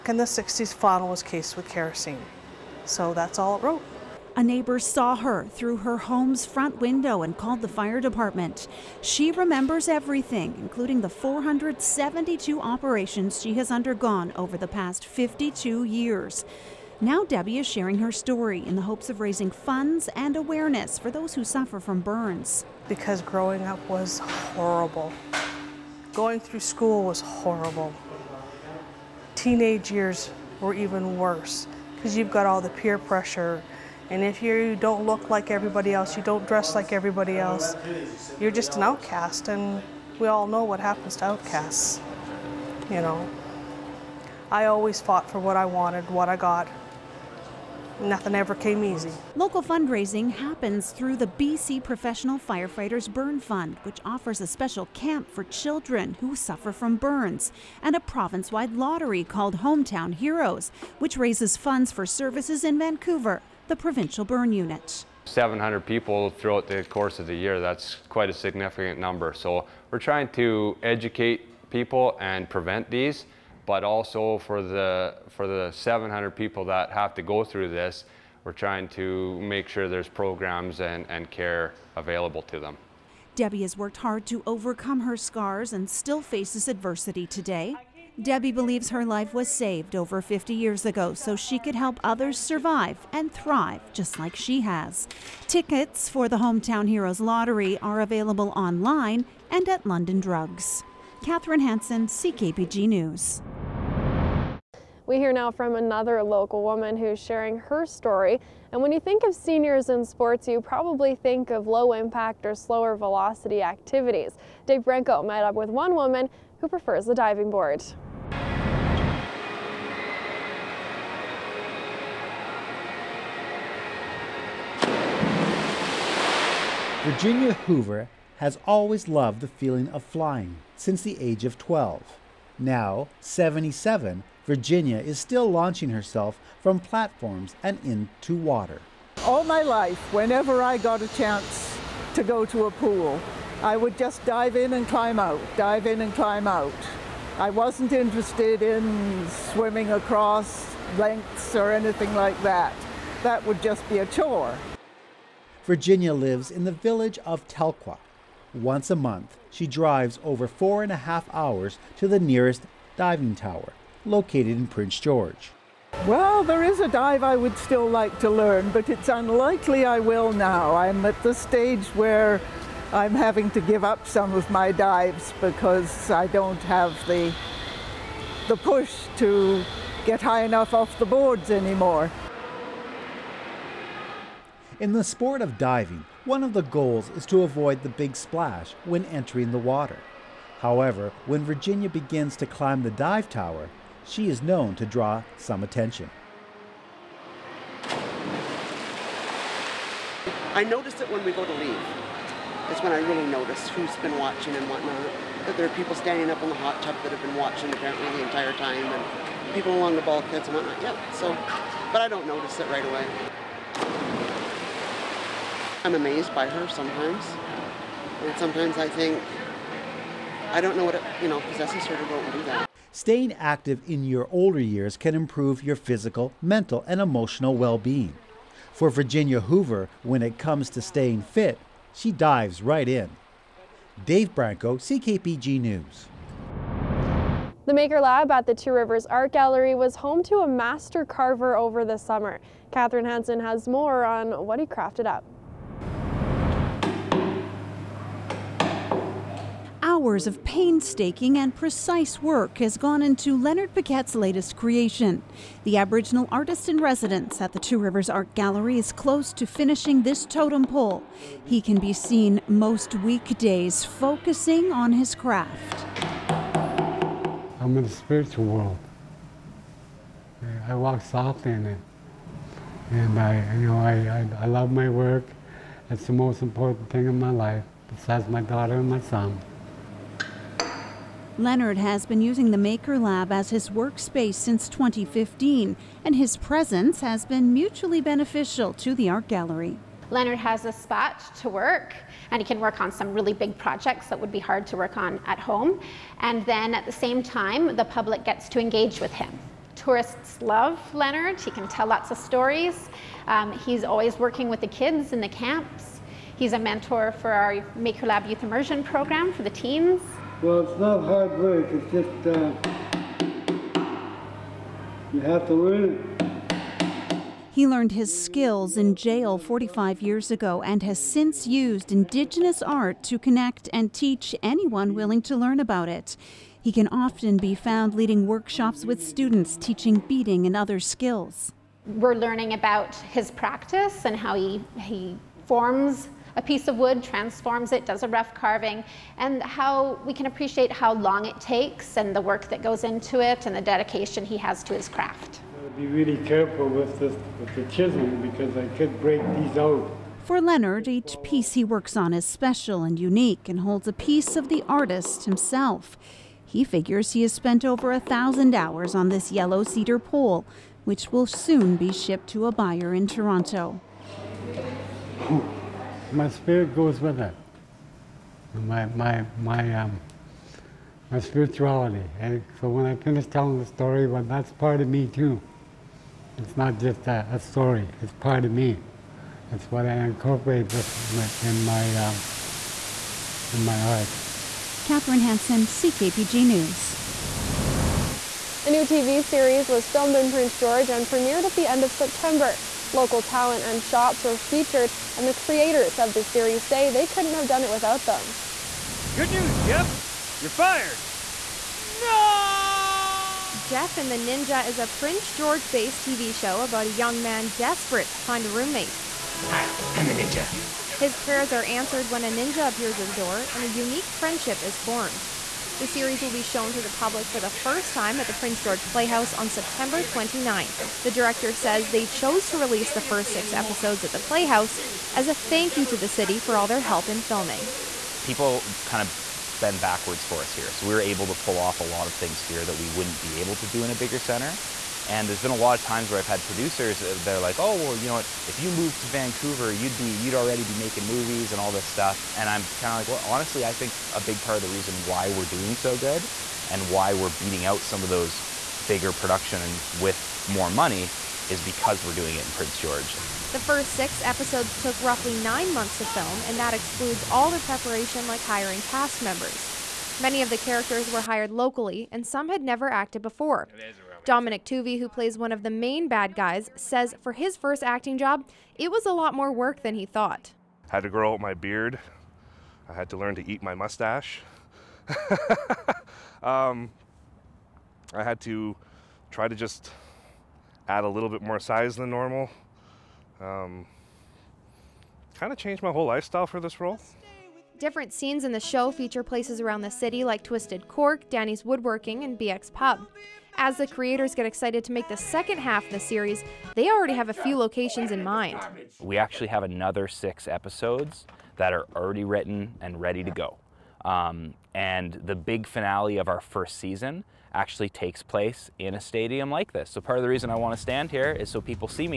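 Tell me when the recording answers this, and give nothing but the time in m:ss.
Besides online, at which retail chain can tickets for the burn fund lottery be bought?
1:39.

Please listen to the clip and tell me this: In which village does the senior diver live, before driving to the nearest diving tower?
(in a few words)
Telkwa.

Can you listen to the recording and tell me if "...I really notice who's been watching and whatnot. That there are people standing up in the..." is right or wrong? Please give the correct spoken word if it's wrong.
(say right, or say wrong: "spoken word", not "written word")
right.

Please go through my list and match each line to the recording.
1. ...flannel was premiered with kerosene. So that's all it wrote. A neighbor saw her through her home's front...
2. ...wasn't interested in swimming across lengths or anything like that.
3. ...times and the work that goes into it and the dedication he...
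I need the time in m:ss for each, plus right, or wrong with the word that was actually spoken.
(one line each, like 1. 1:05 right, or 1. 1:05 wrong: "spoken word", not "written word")
1. 0:00 wrong: "cased", not "premiered"
2. 2:27 right
3. 5:41 wrong: "takes", not "times".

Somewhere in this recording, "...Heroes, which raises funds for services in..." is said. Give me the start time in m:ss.
1:00.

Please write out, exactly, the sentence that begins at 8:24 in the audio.
Um, and the big finale of our first season actually takes place in a stadium like this.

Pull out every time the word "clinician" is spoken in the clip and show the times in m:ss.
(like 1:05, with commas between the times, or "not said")
not said.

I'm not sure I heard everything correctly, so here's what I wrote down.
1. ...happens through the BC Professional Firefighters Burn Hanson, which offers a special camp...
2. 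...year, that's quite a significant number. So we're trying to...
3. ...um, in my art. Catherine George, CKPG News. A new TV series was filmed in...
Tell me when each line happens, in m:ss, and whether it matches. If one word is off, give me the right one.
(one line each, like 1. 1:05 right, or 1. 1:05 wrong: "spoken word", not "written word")
1. 0:50 wrong: "Fund", not "Hanson"
2. 1:07 right
3. 6:21 wrong: "Hanson", not "George".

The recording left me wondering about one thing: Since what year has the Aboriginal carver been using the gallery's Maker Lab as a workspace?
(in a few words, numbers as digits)
2015.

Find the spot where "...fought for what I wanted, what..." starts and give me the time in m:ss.
0:45.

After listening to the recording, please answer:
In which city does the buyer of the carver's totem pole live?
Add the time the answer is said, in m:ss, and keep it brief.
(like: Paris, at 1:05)
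Toronto, at 6:03.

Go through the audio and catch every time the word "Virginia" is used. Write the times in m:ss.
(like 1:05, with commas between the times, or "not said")
2:07, 2:14, 2:35, 3:11, 3:48.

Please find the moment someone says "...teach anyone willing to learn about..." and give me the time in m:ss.
5:23.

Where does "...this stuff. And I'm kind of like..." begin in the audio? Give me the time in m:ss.
7:21.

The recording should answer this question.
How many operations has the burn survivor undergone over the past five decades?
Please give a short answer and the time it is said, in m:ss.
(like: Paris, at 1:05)
472, at 0:11.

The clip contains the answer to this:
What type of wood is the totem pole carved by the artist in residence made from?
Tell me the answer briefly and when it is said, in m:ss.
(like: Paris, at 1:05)
yellow cedar, at 5:59.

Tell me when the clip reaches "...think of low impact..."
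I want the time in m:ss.
1:51.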